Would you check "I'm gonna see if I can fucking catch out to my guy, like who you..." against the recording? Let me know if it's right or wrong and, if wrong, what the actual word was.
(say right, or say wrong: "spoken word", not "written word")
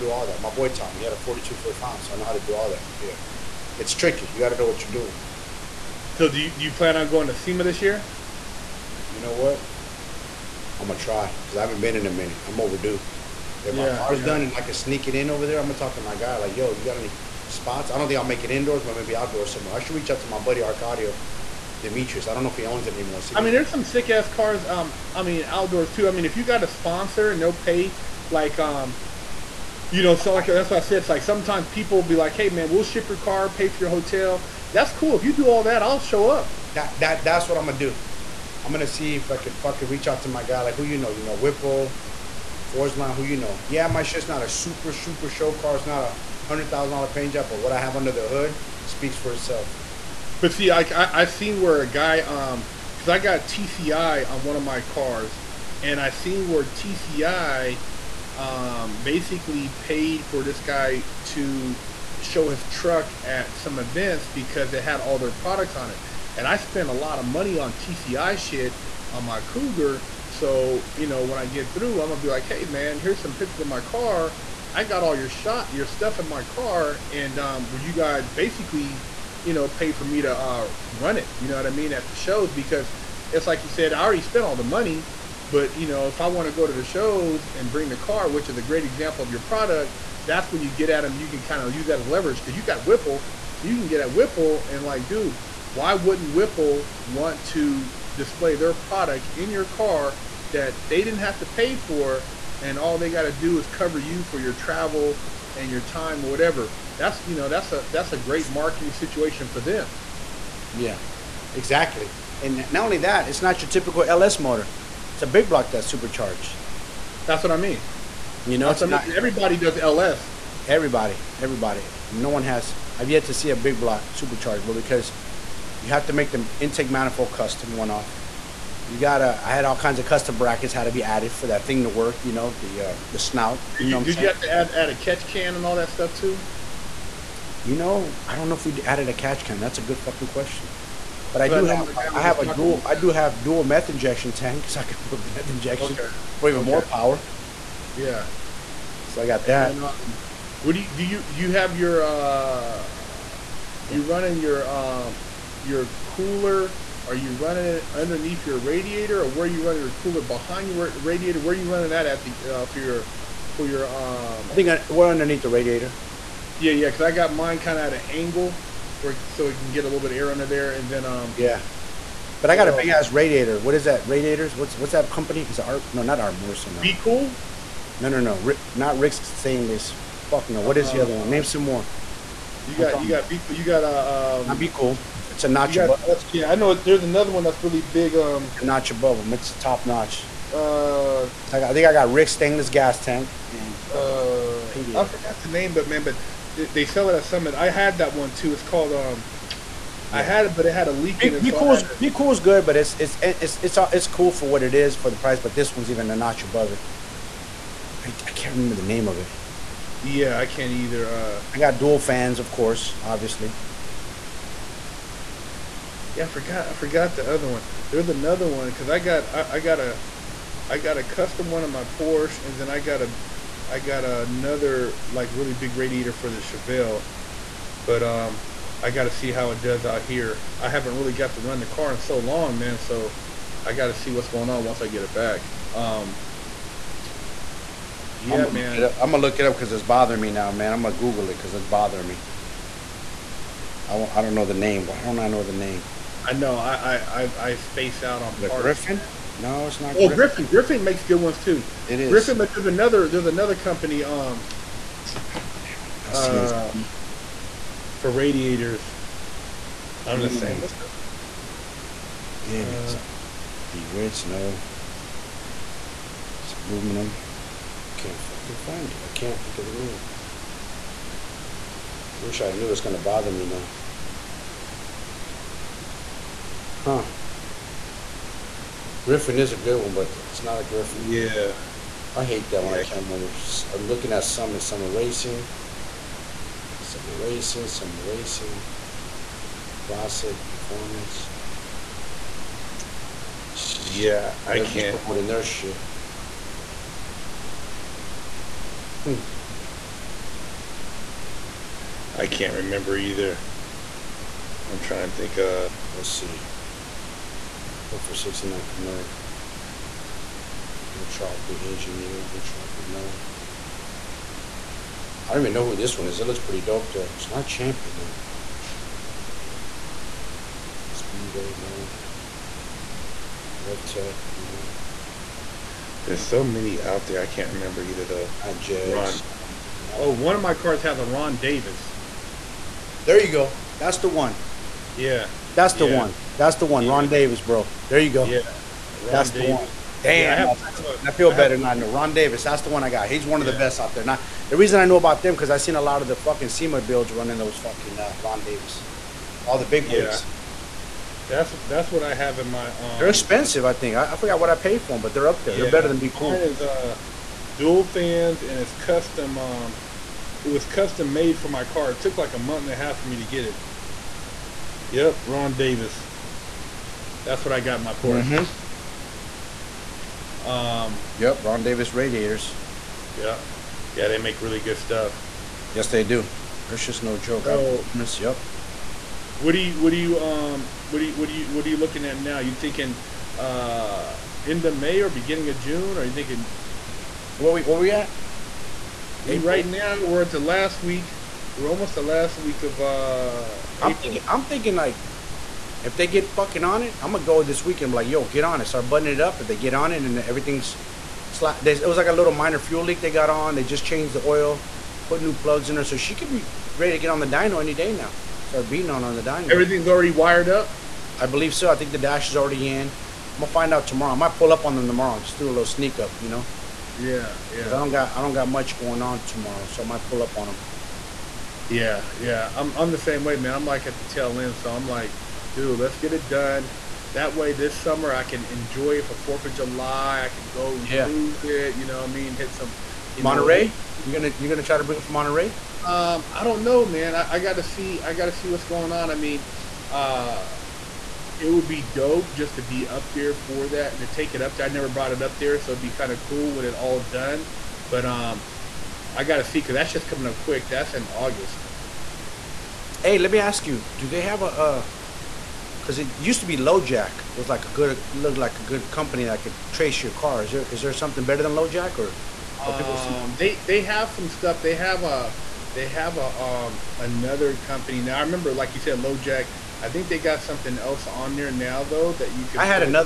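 wrong: "reach", not "catch".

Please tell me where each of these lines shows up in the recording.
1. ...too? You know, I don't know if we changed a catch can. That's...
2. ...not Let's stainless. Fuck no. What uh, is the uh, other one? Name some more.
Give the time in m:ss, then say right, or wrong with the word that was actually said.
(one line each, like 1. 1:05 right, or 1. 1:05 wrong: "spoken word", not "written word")
1. 2:16 wrong: "added", not "changed"
2. 2:58 wrong: "Rick", not "Let".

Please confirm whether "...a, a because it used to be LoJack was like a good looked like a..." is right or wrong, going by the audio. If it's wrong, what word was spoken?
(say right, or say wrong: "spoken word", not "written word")
right.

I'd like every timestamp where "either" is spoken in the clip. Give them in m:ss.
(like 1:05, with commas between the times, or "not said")
3:30, 5:02, 5:27.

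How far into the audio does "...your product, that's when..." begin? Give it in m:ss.
1:29.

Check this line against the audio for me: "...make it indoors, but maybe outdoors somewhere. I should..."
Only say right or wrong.
right.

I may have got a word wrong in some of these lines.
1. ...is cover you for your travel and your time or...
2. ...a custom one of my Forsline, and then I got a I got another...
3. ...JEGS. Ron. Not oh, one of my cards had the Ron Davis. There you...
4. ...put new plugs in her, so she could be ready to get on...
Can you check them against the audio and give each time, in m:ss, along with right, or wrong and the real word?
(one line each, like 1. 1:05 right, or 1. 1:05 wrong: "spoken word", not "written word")
1. 1:43 right
2. 3:40 wrong: "Porsche", not "Forsline"
3. 5:28 right
4. 6:45 right.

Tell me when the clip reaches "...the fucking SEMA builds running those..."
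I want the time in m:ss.
5:46.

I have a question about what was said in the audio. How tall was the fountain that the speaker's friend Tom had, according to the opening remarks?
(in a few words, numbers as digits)
42 feet.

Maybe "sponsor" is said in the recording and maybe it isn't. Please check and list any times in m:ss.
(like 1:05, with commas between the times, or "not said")
0:26.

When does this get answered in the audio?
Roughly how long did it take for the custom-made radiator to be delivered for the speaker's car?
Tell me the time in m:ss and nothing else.
6:02.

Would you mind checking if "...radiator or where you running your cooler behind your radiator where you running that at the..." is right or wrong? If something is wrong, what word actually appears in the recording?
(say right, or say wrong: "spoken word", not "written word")
right.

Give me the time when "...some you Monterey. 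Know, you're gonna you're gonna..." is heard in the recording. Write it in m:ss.
7:12.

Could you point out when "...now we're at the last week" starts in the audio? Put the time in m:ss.
6:29.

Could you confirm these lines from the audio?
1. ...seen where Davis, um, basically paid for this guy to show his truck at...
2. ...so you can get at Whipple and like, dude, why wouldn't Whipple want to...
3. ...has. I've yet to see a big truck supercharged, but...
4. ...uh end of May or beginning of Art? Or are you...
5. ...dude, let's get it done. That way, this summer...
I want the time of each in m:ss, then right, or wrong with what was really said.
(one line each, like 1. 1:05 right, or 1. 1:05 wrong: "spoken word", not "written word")
1. 0:56 wrong: "TCI", not "Davis"
2. 1:33 right
3. 2:02 wrong: "block", not "truck"
4. 6:23 wrong: "June", not "Art"
5. 7:05 right.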